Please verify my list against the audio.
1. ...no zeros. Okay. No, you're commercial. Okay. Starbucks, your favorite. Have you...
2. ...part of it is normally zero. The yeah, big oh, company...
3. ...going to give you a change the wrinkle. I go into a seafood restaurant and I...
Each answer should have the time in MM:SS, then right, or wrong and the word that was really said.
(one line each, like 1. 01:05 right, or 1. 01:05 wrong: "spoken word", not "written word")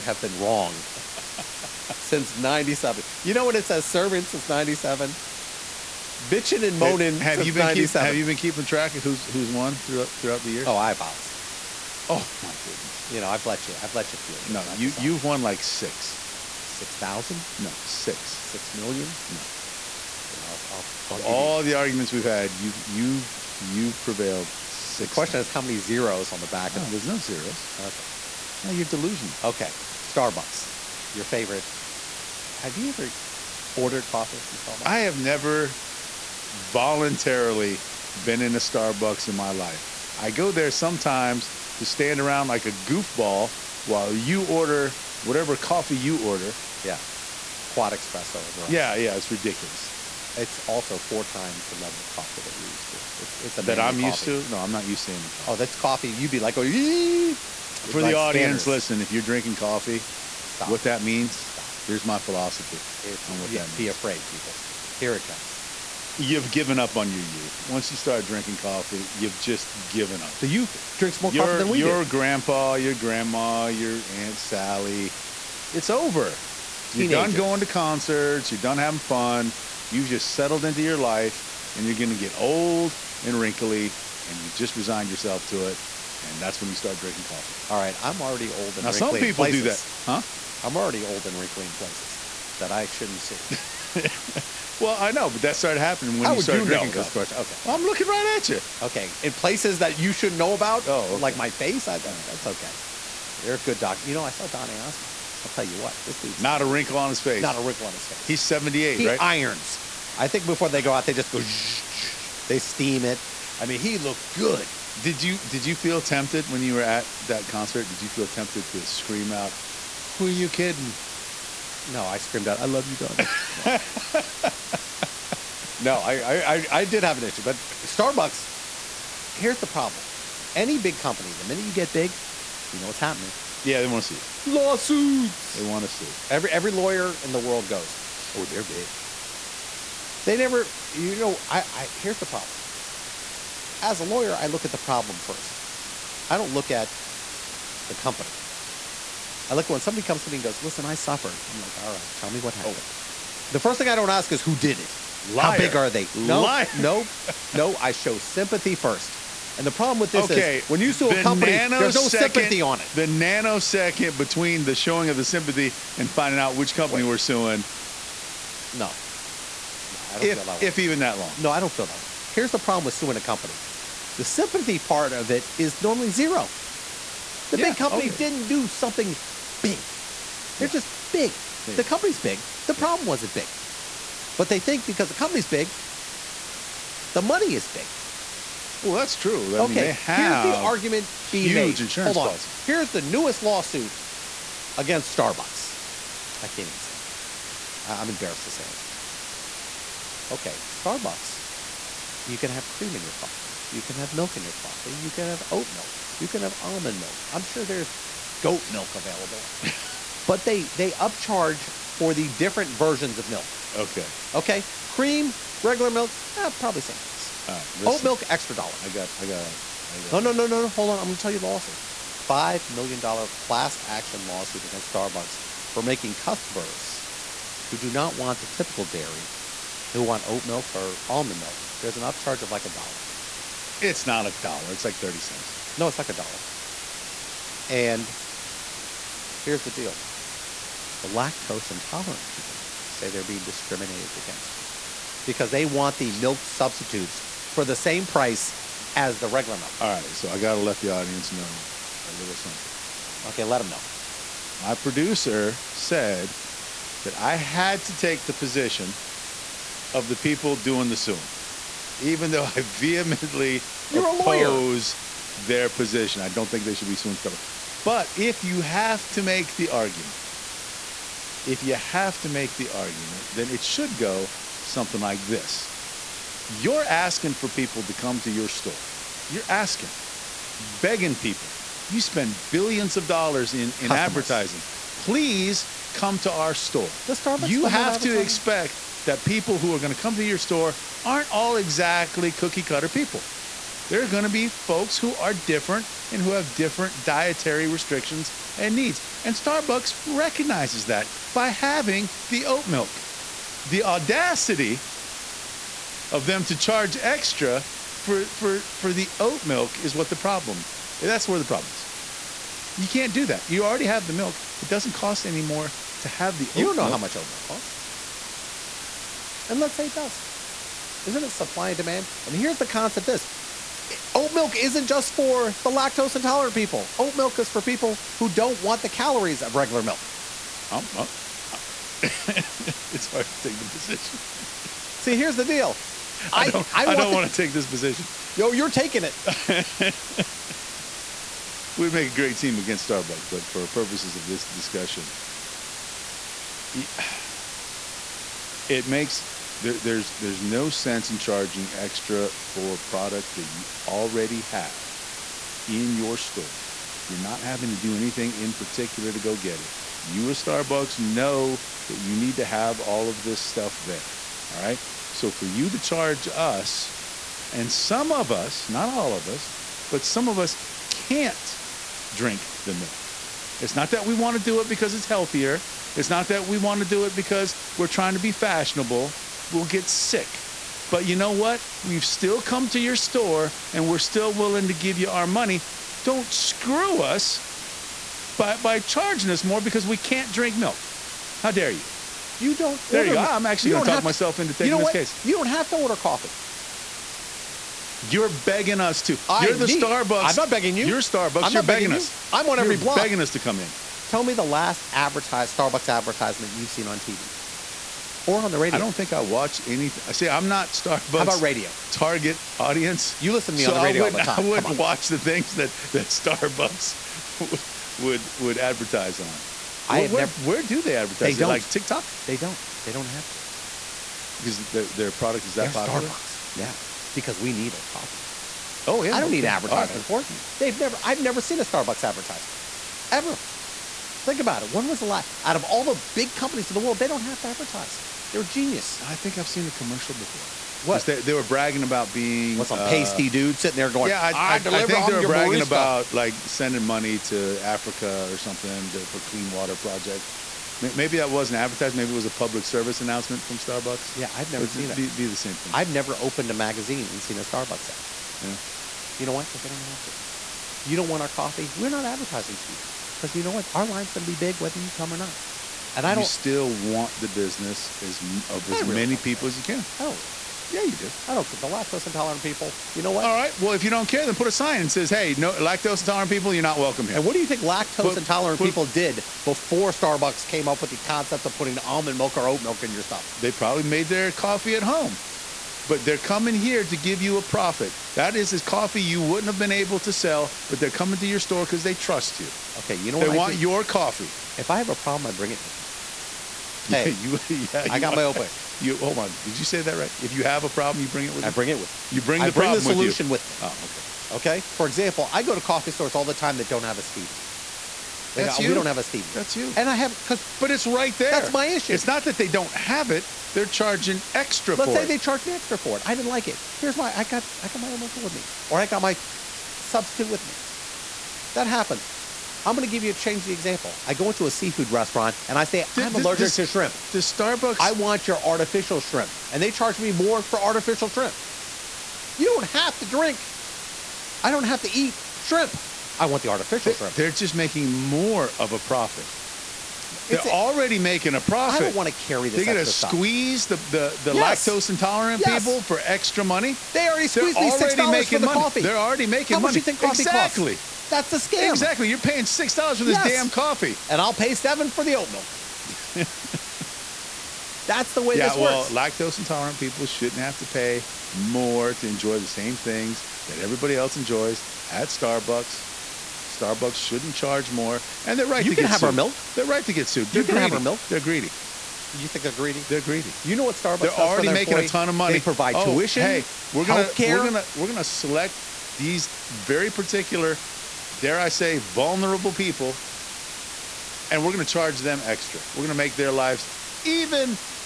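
1. 00:27 wrong: "delusional", not "commercial"
2. 02:54 right
3. 08:42 wrong: "example", not "wrinkle".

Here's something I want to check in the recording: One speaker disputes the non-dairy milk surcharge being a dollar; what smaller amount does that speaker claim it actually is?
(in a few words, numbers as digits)
30 cents.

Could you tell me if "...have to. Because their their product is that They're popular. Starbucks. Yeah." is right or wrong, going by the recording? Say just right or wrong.
right.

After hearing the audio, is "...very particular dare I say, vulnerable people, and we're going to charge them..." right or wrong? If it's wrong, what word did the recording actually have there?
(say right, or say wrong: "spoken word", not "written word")
right.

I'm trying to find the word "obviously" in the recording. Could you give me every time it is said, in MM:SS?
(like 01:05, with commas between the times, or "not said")
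00:11.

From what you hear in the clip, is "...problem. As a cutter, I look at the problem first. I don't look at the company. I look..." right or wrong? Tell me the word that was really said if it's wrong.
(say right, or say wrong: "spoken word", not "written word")
wrong: "lawyer", not "cutter".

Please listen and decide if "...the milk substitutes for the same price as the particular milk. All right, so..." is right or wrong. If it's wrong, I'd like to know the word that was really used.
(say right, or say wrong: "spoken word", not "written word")
wrong: "regular", not "particular".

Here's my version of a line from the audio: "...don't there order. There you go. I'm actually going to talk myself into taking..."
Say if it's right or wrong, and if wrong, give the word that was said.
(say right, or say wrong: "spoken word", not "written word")
right.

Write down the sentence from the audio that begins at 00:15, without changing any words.
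you've won like 6 six thousand?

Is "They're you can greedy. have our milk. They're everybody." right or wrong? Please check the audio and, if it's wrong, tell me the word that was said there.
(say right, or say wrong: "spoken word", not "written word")
wrong: "greedy", not "everybody".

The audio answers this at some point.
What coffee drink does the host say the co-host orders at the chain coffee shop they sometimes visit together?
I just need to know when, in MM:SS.
00:47.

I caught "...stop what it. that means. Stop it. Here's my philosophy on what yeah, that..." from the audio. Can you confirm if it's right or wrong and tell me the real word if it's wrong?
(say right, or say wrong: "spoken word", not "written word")
right.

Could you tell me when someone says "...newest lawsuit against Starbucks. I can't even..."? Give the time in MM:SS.
03:13.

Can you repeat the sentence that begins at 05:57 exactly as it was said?
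You're not having to do anything in particular to go get it.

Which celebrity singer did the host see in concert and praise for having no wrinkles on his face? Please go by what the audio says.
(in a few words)
Donny Osmond.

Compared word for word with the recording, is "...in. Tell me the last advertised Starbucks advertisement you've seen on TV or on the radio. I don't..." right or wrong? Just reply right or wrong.
right.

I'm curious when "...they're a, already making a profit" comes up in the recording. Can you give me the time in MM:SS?
09:00.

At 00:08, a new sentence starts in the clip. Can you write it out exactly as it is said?
Keep, have you been keeping track of who's who's won throughout throughout the years?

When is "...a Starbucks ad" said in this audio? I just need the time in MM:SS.
07:37.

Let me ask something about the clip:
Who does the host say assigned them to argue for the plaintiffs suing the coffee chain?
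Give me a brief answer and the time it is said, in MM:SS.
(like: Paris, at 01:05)
My producer, at 04:14.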